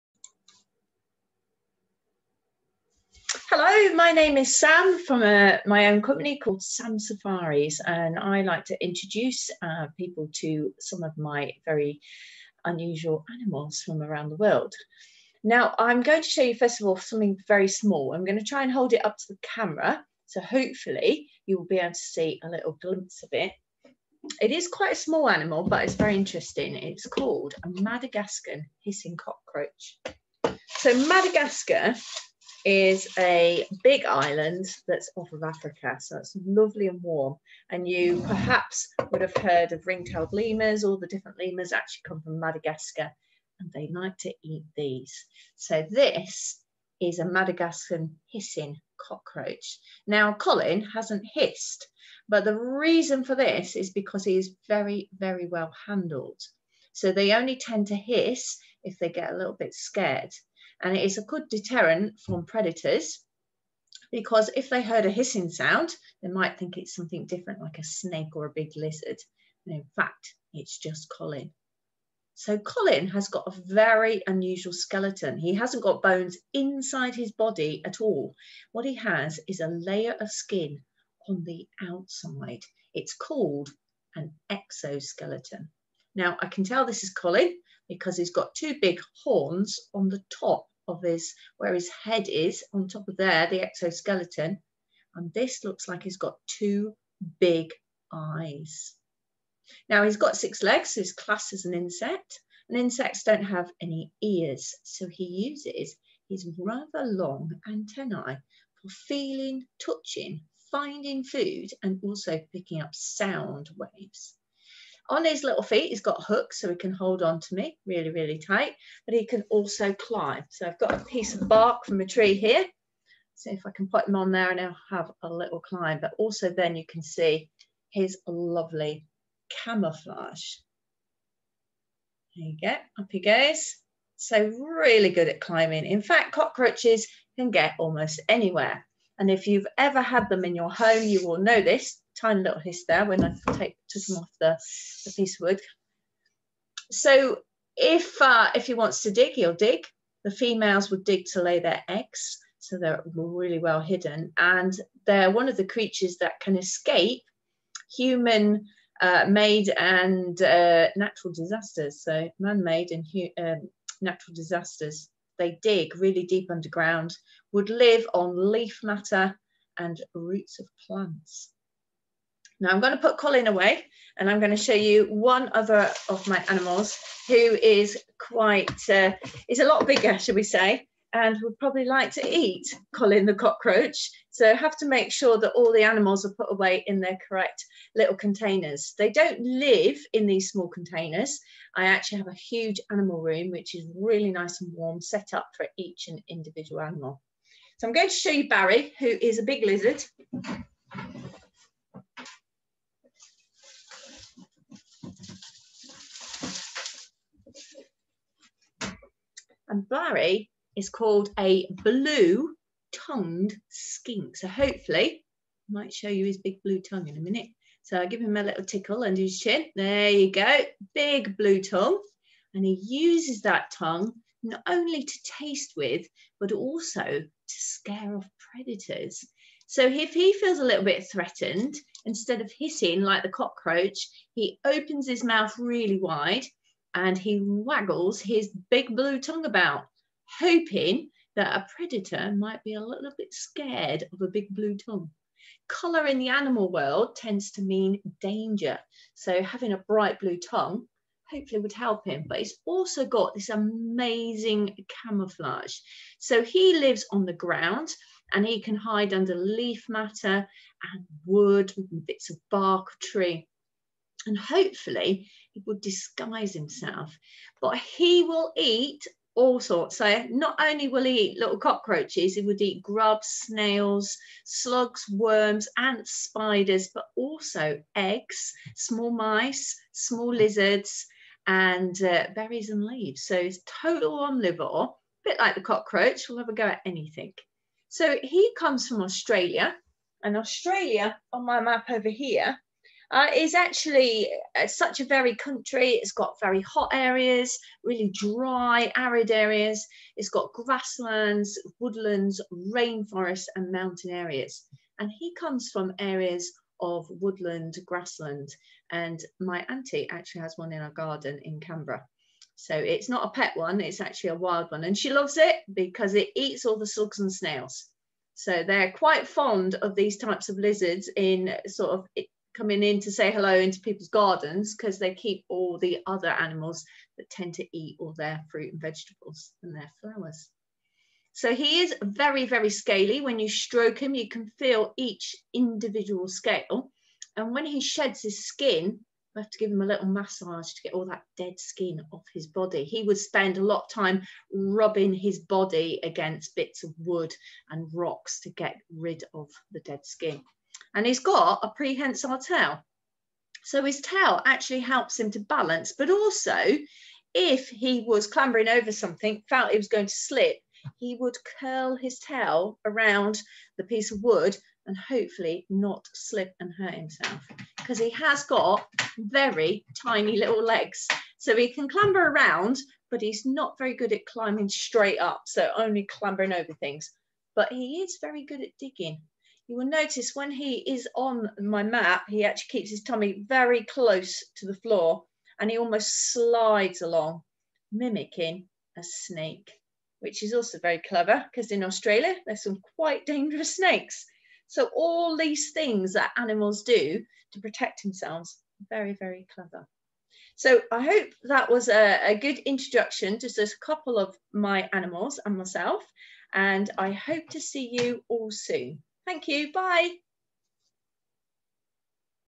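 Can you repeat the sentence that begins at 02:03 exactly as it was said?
See if I can put him on there and he'll have a little climb.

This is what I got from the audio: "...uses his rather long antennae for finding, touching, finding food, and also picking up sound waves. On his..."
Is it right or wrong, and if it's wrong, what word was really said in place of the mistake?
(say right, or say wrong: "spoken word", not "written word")
wrong: "feeling", not "finding".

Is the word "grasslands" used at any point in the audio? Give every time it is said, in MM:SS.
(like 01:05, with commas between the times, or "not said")
05:00, 05:07.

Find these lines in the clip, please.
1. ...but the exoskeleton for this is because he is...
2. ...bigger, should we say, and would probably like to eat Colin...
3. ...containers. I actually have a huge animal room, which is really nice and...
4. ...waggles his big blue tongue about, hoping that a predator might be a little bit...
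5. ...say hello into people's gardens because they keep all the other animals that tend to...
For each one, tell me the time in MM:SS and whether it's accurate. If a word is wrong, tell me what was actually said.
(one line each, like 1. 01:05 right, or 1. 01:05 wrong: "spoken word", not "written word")
1. 00:52 wrong: "reason", not "exoskeleton"
2. 02:59 right
3. 03:10 right
4. 03:57 right
5. 05:23 right.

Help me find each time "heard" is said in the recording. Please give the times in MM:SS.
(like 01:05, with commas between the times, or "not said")
00:39, 01:04.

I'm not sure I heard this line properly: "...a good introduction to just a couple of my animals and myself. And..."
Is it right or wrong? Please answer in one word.
right.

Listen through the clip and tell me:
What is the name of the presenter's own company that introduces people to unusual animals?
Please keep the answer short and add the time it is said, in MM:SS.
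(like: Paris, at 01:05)
Sam Safaris, at 00:06.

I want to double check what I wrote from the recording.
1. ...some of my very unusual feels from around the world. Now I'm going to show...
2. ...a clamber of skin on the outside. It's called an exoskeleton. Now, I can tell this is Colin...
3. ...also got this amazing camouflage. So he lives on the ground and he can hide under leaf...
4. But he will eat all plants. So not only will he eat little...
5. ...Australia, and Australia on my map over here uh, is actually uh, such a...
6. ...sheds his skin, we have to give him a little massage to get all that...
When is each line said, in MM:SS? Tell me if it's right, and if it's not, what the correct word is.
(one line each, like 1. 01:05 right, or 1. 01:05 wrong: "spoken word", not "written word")
1. 00:10 wrong: "animals", not "feels"
2. 01:19 wrong: "layer", not "clamber"
3. 04:12 right
4. 04:27 wrong: "sorts", not "plants"
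5. 04:49 right
6. 05:37 right.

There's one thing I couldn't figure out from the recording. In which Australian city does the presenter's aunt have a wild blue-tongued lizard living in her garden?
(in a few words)
Canberra.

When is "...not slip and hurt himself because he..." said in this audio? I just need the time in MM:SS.
06:05.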